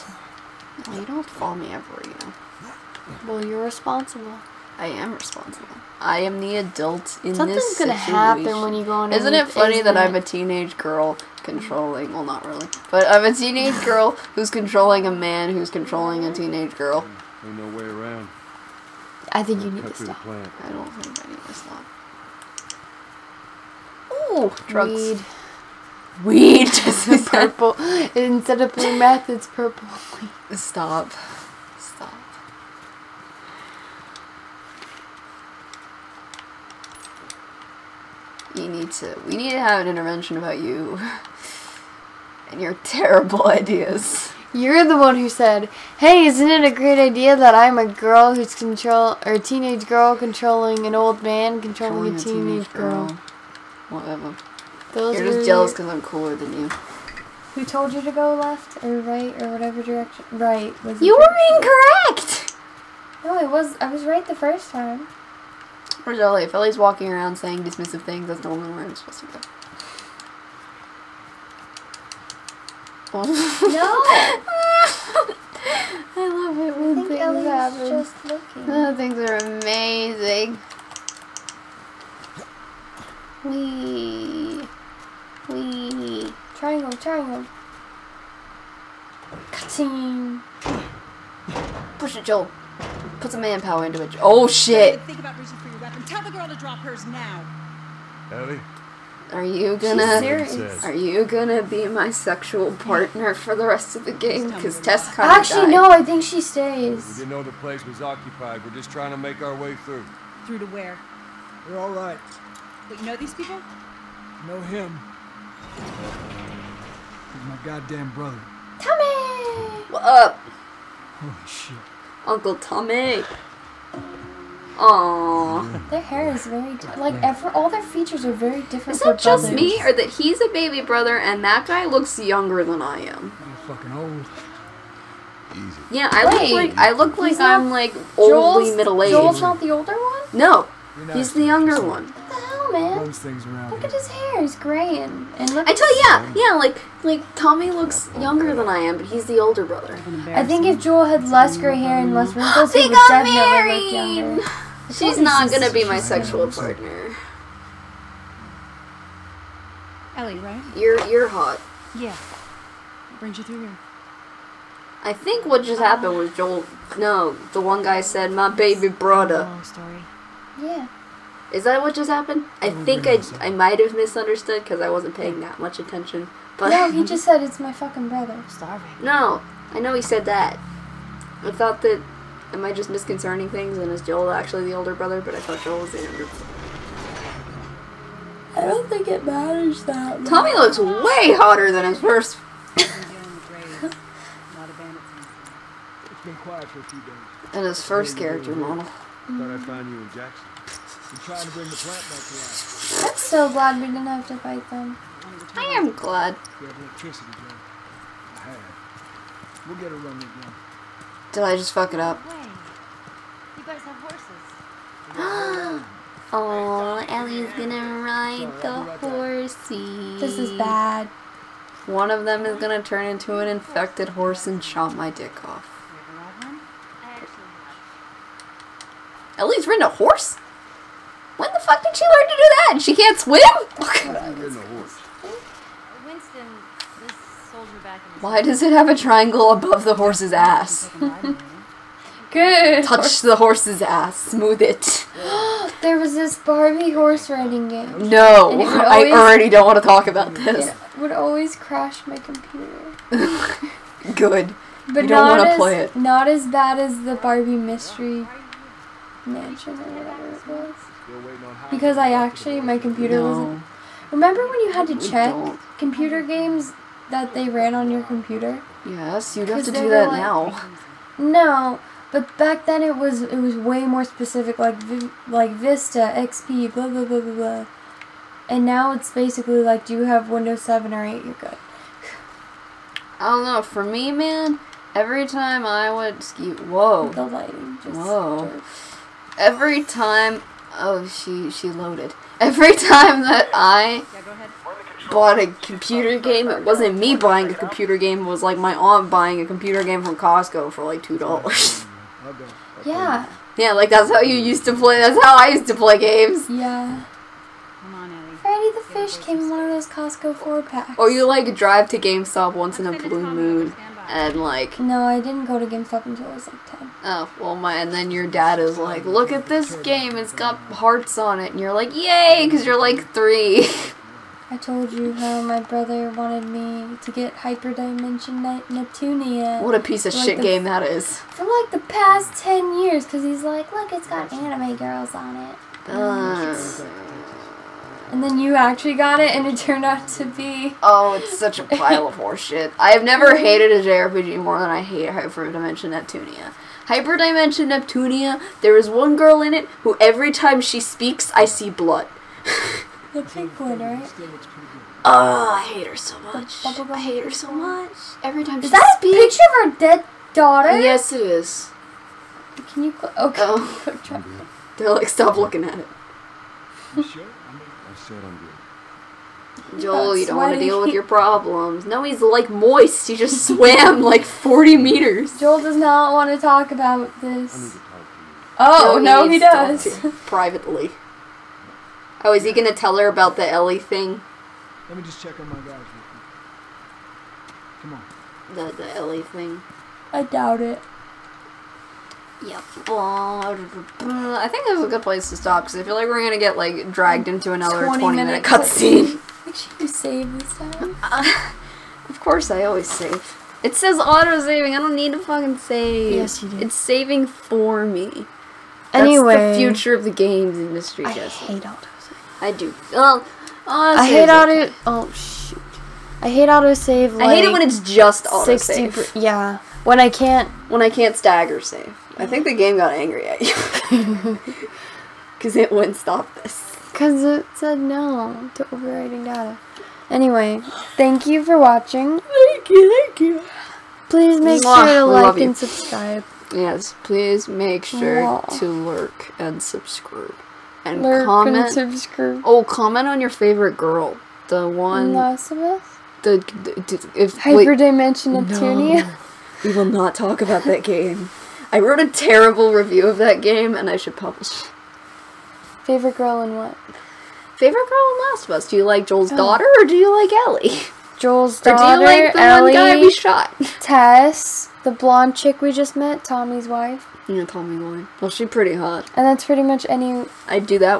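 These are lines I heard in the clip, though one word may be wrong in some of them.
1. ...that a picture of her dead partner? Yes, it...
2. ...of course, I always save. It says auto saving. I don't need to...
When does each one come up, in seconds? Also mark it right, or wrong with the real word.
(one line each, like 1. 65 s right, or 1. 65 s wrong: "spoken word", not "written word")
1. 358 s wrong: "daughter", not "partner"
2. 402 s right.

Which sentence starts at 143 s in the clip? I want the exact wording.
at his hair; he's gray and and look.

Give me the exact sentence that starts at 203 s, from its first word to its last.
I'm so glad we didn't have to fight them.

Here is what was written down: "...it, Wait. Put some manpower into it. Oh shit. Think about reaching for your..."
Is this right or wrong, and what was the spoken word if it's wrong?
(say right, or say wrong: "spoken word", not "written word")
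wrong: "Joel", not "Wait".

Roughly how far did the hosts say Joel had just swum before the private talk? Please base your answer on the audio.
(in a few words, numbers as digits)
40 meters.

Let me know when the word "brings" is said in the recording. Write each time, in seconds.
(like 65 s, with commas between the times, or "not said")
163 s, 201 s.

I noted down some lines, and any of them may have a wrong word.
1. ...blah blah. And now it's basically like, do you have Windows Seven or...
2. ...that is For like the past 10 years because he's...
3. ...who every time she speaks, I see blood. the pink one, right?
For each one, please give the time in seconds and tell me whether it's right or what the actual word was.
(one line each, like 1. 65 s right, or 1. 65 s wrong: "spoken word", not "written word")
1. 277 s right
2. 330 s right
3. 349 s right.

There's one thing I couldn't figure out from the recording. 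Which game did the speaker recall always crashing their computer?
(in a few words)
Barbie horse riding game.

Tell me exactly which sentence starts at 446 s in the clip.
The, the, the if, Hyperdimension Neptunia?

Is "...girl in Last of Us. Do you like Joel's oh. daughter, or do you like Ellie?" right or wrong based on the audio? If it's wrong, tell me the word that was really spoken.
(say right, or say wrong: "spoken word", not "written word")
right.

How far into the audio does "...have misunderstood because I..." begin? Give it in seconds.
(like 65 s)
173 s.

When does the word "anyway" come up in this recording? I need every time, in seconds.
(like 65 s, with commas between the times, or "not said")
409 s, 430 s.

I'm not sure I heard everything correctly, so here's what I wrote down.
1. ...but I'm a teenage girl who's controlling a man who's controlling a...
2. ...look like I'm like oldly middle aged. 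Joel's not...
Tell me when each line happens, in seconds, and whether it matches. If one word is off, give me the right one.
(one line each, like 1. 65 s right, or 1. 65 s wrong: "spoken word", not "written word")
1. 12 s right
2. 136 s right.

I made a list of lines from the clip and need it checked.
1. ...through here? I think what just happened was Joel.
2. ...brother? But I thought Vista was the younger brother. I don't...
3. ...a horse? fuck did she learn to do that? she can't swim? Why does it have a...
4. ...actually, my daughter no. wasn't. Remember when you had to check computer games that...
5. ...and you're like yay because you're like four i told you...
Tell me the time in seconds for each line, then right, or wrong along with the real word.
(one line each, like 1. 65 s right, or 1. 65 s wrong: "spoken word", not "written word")
1. 163 s right
2. 184 s wrong: "Joel", not "Vista"
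3. 229 s right
4. 262 s wrong: "computer", not "daughter"
5. 321 s wrong: "three", not "four".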